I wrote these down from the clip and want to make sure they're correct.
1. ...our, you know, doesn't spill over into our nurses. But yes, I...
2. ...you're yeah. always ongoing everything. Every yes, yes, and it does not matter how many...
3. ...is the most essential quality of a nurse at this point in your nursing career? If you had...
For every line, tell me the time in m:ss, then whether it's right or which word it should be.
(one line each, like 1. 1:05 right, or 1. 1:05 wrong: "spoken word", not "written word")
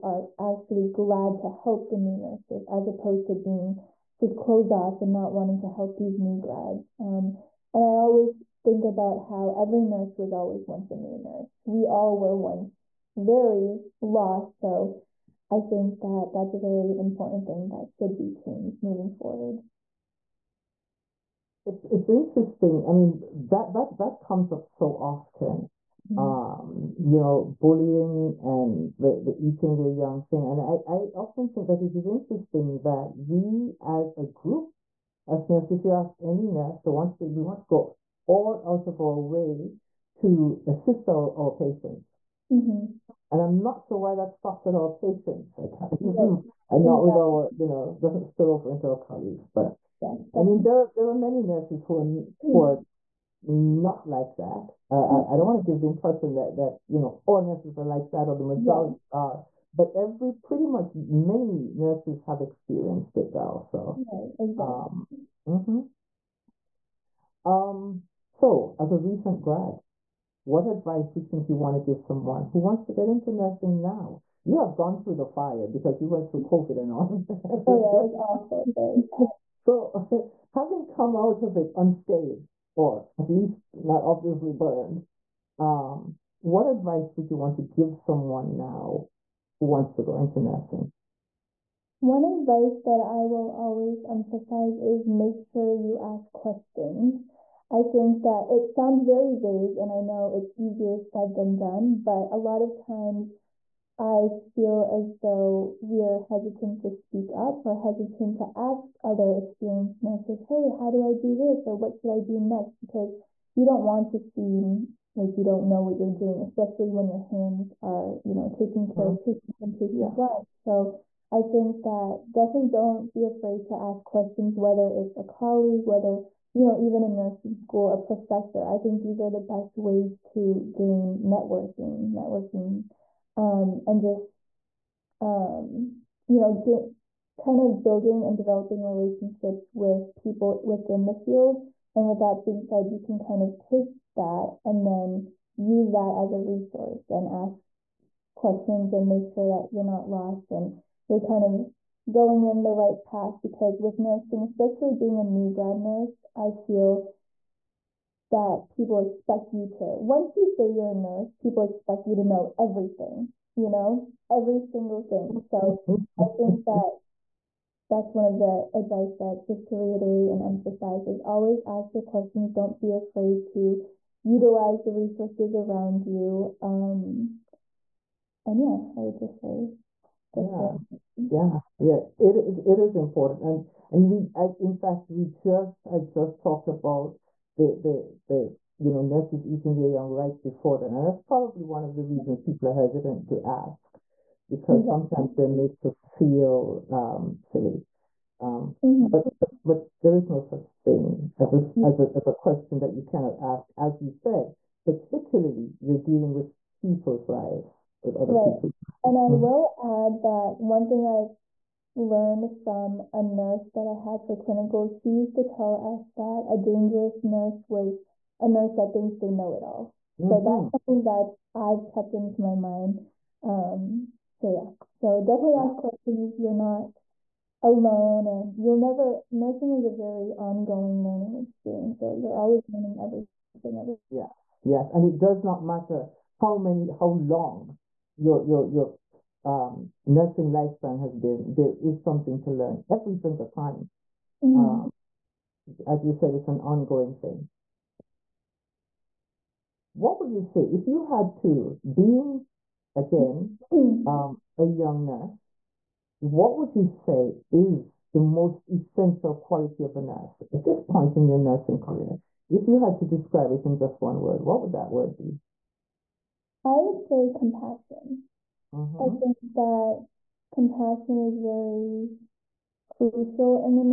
1. 0:47 wrong: "colleagues", not "nurses"
2. 3:52 wrong: "learning", not "ongoing"
3. 4:17 right.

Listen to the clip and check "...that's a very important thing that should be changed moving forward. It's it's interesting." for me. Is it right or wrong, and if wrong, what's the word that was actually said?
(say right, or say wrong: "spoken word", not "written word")
right.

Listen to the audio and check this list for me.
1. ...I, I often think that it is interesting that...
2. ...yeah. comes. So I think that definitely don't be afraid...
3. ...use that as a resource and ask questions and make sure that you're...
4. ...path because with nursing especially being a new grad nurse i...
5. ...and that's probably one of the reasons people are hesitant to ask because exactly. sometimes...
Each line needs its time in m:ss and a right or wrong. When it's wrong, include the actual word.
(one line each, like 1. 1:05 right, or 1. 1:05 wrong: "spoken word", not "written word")
1. 0:30 right
2. 2:00 wrong: "lives", not "comes"
3. 2:25 right
4. 2:33 right
5. 3:10 right.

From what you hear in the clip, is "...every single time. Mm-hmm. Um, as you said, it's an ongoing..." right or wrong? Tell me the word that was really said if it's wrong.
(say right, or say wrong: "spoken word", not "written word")
right.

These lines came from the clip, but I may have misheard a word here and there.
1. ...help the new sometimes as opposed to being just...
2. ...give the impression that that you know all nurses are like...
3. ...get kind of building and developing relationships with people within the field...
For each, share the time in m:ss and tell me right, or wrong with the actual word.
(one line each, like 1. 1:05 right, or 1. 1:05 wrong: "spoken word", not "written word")
1. 0:01 wrong: "nurses", not "sometimes"
2. 0:55 right
3. 2:16 right.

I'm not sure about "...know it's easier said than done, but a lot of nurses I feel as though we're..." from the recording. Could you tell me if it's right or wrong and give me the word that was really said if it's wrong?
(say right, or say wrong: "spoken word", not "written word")
wrong: "times", not "nurses".